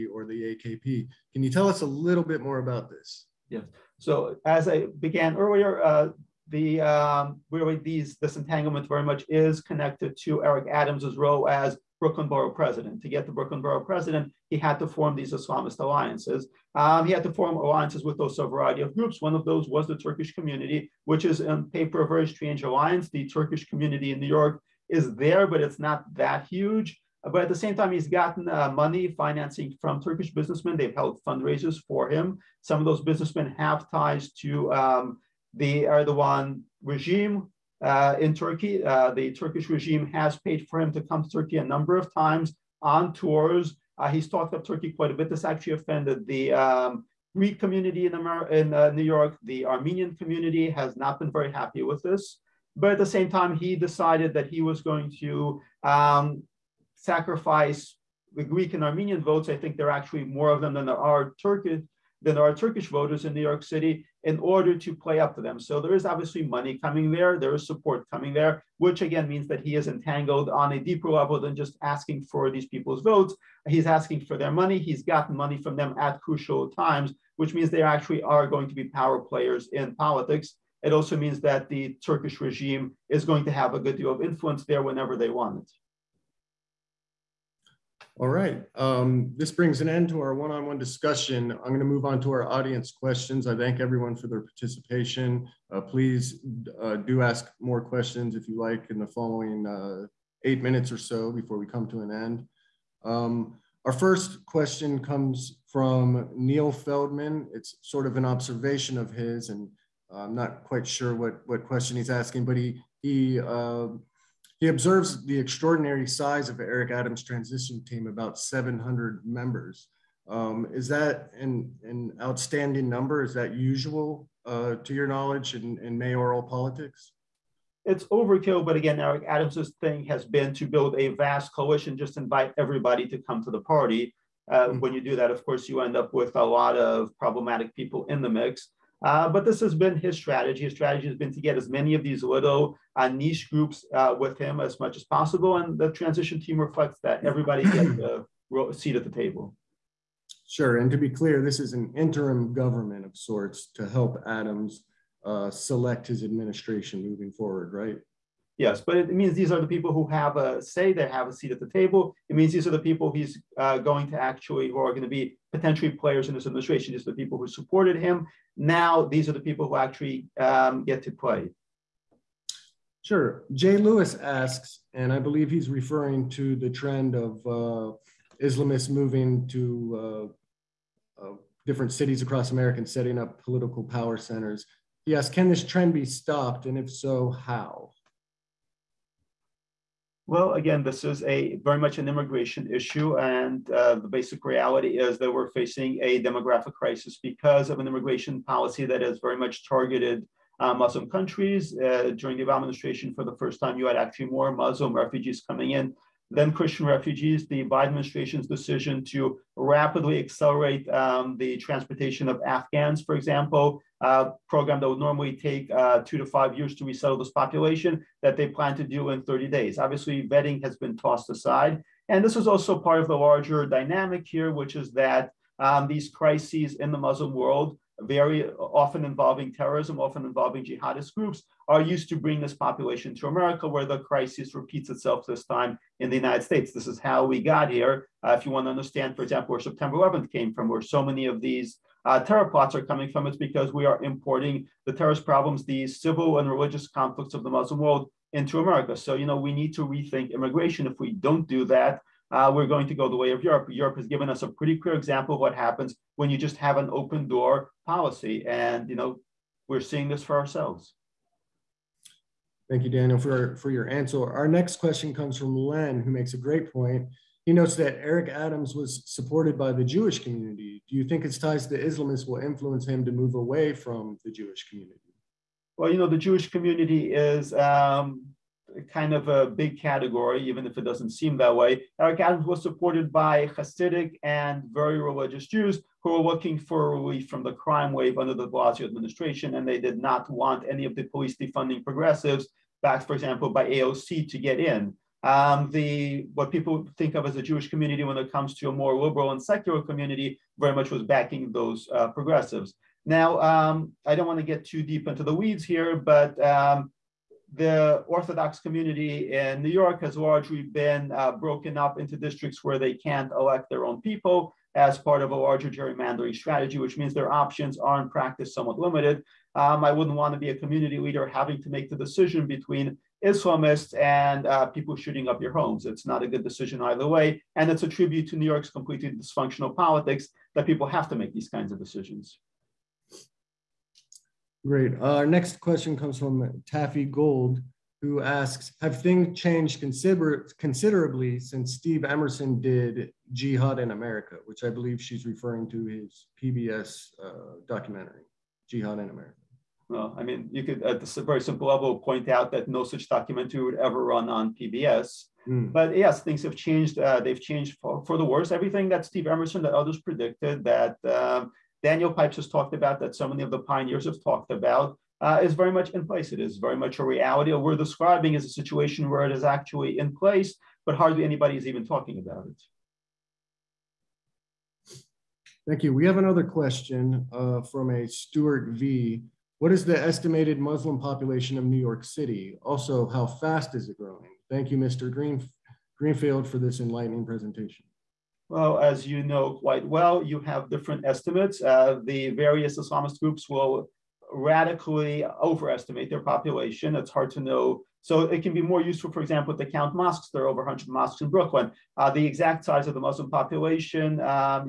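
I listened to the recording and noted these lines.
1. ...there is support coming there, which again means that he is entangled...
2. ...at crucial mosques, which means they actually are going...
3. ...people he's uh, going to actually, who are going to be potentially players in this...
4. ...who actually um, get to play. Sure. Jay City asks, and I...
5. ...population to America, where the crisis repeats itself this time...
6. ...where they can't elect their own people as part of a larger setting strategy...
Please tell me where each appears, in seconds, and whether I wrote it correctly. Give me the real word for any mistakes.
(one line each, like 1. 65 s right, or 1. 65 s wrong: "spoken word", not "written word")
1. 67 s right
2. 75 s wrong: "times", not "mosques"
3. 162 s right
4. 169 s wrong: "Lewis", not "City"
5. 232 s right
6. 312 s wrong: "gerrymandering", not "setting".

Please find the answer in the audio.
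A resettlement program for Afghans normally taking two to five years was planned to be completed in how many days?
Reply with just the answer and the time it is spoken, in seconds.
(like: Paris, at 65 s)
30, at 219 s.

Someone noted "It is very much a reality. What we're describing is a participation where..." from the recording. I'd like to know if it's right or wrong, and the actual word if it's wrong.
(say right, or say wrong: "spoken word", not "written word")
wrong: "situation", not "participation".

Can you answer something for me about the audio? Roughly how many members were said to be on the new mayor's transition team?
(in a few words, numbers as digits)
700.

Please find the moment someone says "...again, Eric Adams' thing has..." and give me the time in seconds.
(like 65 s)
128 s.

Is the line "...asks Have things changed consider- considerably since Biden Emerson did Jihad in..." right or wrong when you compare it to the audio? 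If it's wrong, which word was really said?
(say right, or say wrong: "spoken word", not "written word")
wrong: "Steve", not "Biden".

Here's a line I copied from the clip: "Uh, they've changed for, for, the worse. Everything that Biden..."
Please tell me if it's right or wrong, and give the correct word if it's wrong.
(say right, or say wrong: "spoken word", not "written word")
wrong: "Steve", not "Biden".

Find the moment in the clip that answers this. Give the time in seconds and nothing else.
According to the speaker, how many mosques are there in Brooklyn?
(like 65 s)
400 s.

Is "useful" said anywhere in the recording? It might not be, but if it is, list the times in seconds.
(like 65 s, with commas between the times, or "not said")
398 s.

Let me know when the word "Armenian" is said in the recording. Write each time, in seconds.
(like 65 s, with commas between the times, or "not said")
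49 s, 58 s.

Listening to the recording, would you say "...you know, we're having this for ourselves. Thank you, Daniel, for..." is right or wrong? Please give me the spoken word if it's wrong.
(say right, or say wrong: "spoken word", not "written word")
wrong: "seeing", not "having".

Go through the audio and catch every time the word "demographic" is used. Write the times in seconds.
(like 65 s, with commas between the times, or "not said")
196 s.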